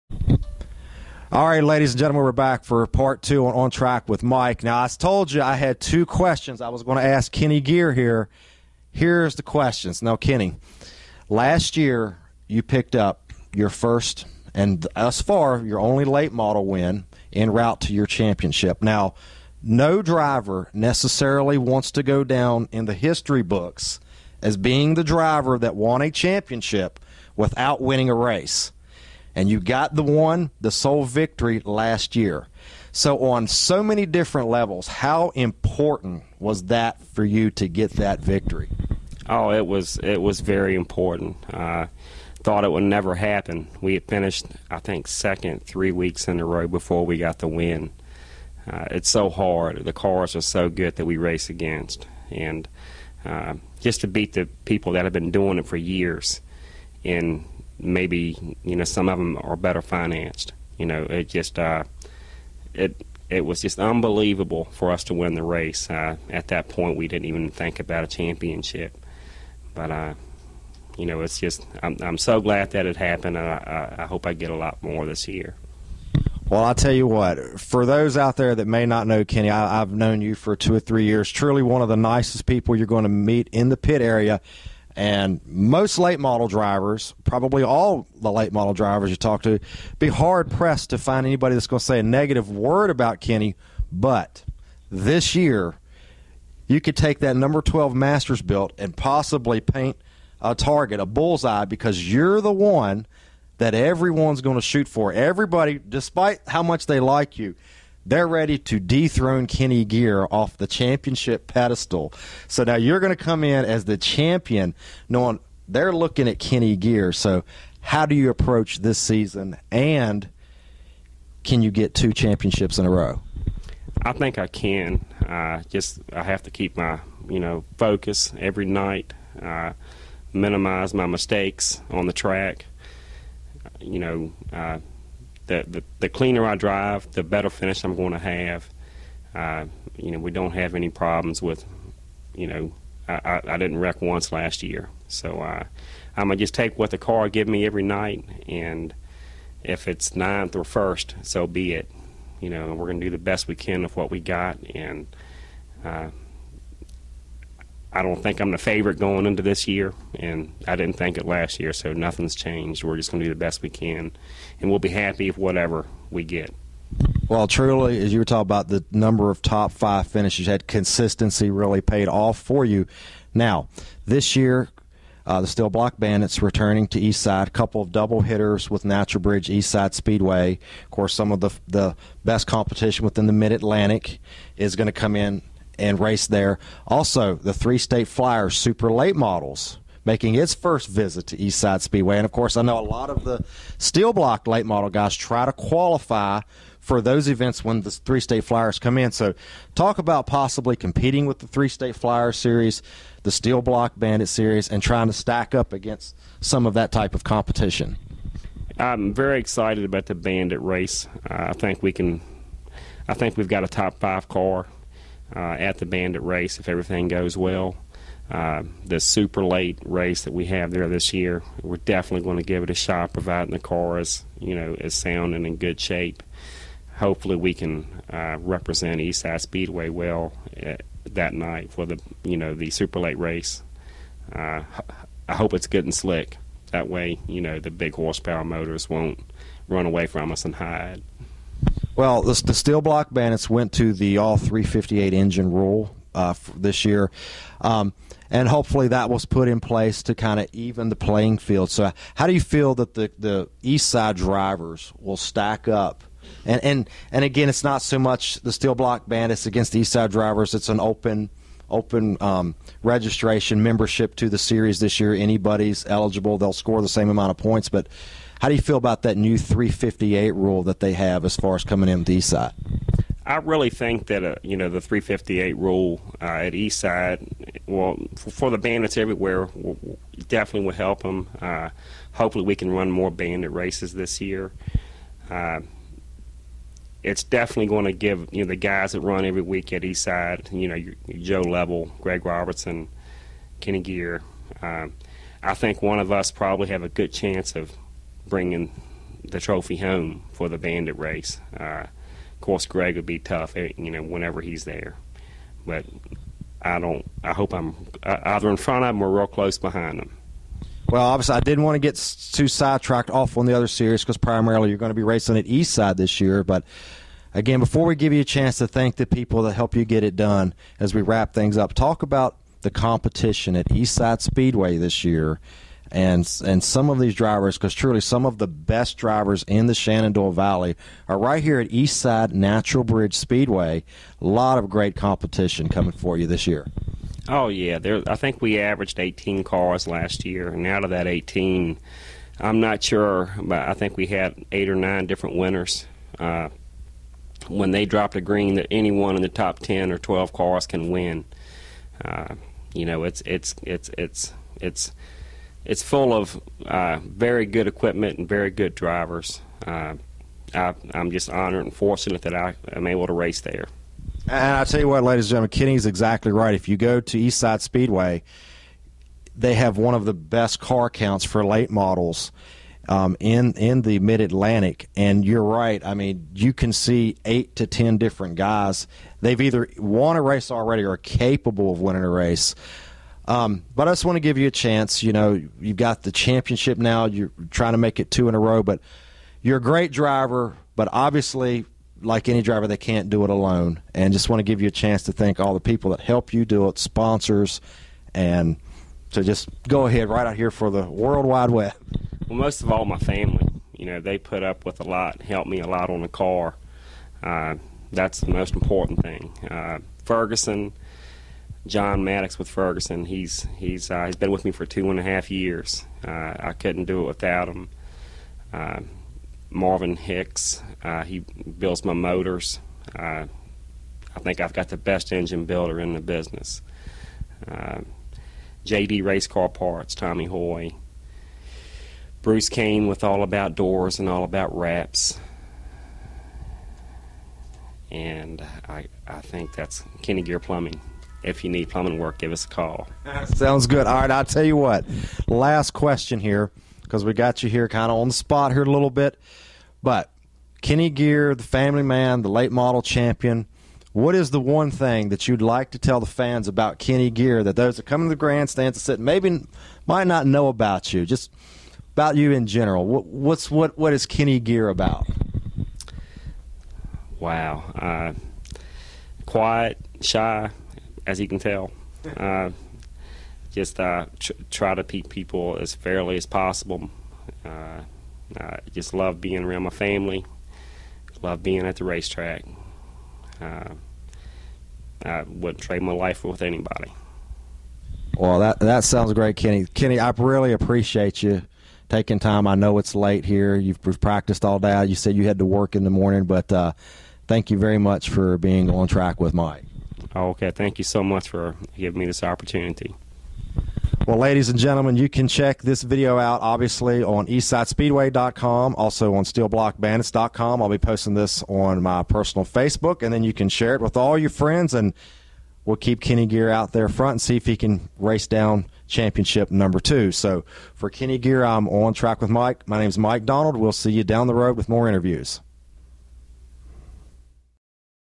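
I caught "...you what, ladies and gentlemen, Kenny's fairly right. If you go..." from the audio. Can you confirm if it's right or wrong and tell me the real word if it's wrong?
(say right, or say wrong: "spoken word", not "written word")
wrong: "exactly", not "fairly".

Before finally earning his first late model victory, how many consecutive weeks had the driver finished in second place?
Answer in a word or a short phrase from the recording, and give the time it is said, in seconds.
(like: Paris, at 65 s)
3, at 45 s.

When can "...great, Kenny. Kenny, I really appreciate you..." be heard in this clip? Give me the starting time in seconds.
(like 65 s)
489 s.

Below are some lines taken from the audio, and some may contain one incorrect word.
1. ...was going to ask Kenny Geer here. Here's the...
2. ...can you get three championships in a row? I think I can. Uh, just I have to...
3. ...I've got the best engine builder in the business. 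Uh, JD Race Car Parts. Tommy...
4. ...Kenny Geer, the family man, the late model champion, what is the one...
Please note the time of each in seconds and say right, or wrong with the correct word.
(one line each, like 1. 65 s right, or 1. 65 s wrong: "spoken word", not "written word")
1. 6 s right
2. 121 s wrong: "two", not "three"
3. 424 s right
4. 450 s right.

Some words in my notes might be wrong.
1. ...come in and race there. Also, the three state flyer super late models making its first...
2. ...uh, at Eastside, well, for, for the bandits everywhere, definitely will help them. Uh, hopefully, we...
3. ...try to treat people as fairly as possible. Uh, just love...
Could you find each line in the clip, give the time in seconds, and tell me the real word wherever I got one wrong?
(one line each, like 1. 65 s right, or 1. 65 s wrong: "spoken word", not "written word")
1. 184 s right
2. 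276 s right
3. 474 s right.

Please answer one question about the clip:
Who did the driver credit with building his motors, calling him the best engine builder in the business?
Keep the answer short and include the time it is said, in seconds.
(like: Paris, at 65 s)
Marvin Hicks, at 419 s.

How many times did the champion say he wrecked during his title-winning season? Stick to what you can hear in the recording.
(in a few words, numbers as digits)
0.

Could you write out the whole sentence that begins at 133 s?
You know, uh, the, the, cleaner I drive, the better finish I'm going to have.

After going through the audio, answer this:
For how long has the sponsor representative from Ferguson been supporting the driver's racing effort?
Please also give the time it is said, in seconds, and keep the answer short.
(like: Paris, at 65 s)
2.5 years, at 414 s.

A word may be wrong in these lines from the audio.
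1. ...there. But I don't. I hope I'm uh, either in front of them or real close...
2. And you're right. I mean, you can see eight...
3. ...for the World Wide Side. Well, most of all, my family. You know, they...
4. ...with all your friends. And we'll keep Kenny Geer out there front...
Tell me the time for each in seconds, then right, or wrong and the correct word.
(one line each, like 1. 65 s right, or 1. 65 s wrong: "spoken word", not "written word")
1. 304 s right
2. 374 s right
3. 400 s wrong: "Web", not "Side"
4. 513 s right.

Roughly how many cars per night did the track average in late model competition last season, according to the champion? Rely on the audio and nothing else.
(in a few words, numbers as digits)
18.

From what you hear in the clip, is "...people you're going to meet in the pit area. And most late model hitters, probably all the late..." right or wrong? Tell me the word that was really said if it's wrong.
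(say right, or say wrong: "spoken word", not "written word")
wrong: "drivers", not "hitters".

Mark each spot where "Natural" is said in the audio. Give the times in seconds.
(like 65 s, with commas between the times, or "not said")
178 s, 332 s.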